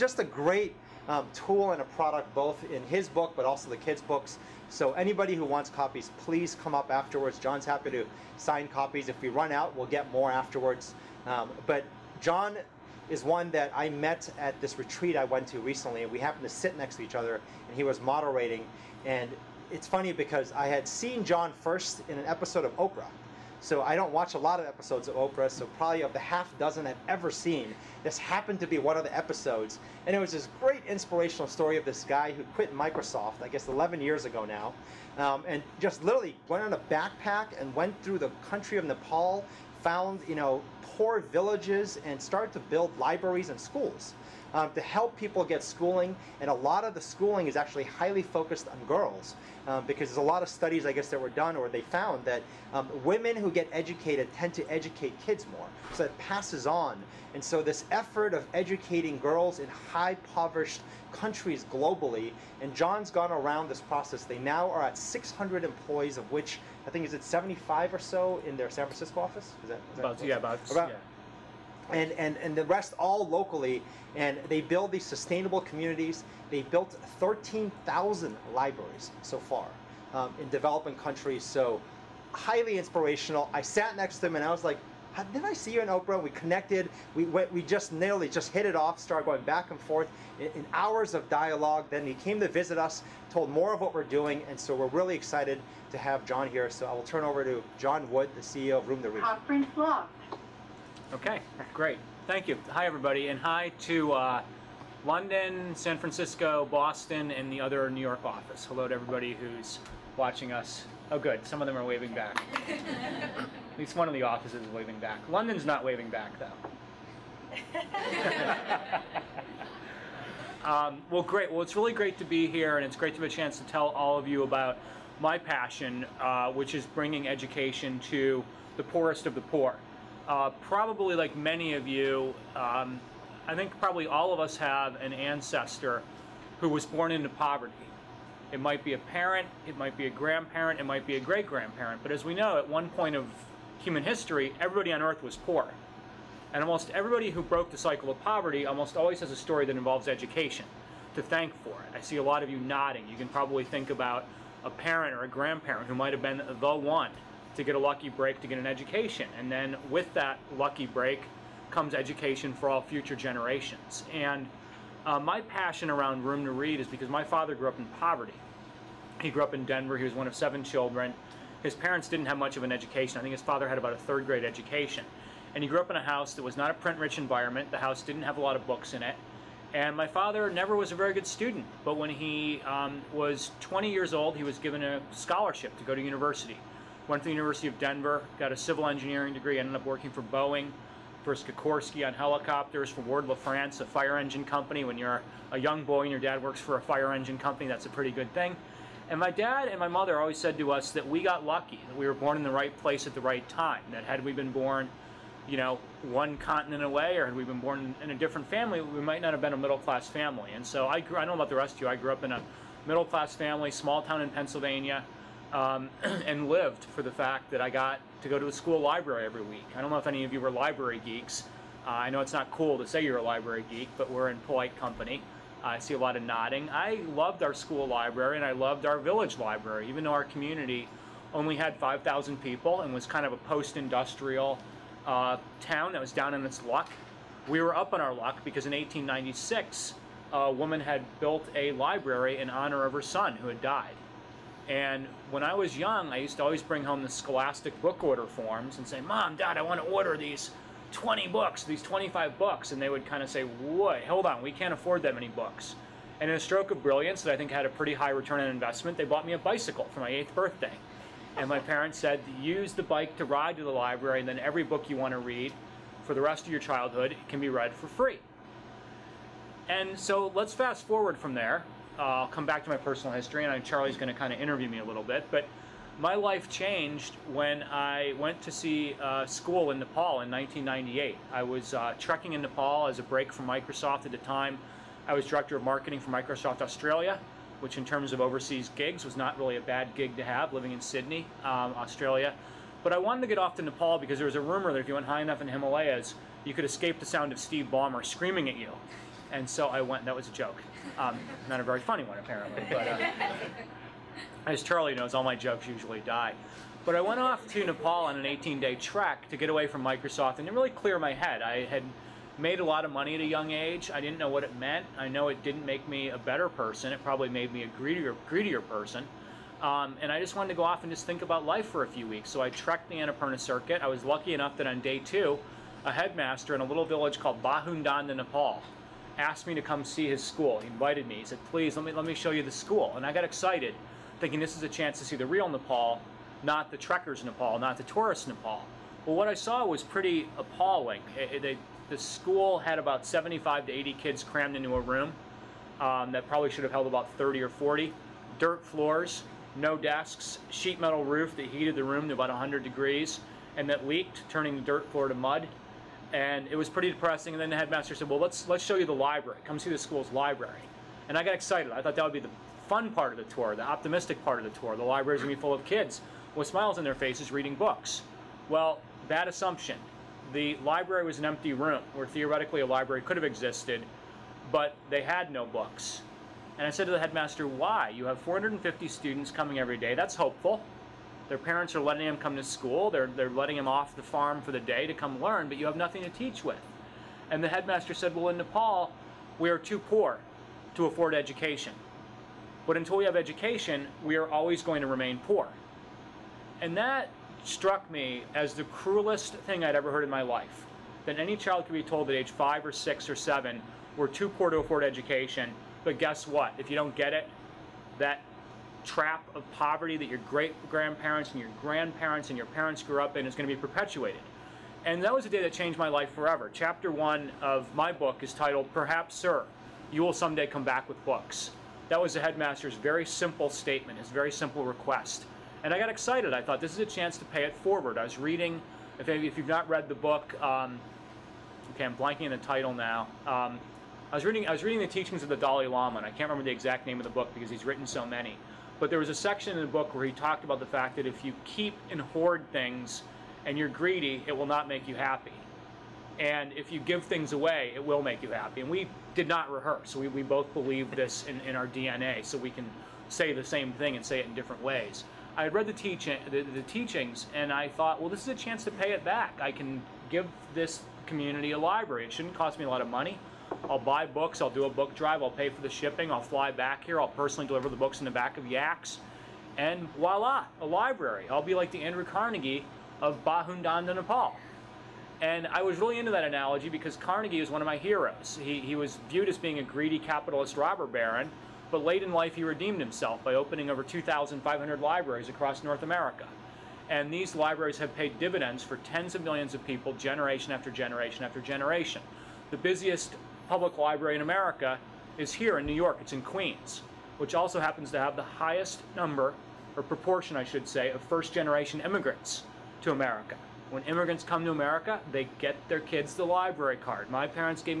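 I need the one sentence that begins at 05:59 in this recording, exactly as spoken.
Come see the school's library." And I got excited.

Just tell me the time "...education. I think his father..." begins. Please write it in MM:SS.
02:52.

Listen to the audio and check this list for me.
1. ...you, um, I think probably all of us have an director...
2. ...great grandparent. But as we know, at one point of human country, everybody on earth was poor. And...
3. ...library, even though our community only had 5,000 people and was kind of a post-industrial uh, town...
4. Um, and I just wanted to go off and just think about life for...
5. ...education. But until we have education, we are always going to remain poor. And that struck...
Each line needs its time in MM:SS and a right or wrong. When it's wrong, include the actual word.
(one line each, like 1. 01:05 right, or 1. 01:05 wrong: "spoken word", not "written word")
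1. 02:11 wrong: "ancestor", not "director"
2. 02:21 wrong: "history", not "country"
3. 03:49 right
4. 05:19 right
5. 06:31 right.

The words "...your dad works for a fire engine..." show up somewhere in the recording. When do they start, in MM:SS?
03:16.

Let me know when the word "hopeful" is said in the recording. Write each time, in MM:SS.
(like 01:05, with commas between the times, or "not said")
06:20.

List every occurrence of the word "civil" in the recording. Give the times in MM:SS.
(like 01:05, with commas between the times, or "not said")
03:08.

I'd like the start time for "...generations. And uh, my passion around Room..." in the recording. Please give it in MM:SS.
02:43.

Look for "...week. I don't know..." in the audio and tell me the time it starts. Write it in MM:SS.
03:39.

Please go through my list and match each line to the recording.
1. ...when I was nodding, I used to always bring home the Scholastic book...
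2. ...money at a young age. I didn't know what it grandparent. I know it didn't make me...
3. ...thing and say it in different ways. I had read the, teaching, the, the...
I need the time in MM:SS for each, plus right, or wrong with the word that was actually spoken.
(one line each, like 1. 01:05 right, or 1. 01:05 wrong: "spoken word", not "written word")
1. 04:05 wrong: "young", not "nodding"
2. 05:12 wrong: "meant", not "grandparent"
3. 07:33 right.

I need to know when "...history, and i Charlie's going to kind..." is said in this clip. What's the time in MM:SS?
04:33.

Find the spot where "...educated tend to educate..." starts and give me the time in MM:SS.
00:53.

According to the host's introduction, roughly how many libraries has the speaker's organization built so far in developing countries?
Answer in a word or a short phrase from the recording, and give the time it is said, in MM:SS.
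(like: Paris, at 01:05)
13,000, at 01:17.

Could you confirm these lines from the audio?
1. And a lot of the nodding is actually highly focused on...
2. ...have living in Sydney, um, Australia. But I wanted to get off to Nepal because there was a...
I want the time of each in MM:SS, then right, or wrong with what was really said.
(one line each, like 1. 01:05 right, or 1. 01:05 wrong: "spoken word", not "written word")
1. 00:46 wrong: "schooling", not "nodding"
2. 04:50 right.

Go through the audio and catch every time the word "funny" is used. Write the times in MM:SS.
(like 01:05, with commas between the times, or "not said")
00:19, 05:01.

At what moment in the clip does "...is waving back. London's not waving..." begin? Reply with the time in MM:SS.
01:54.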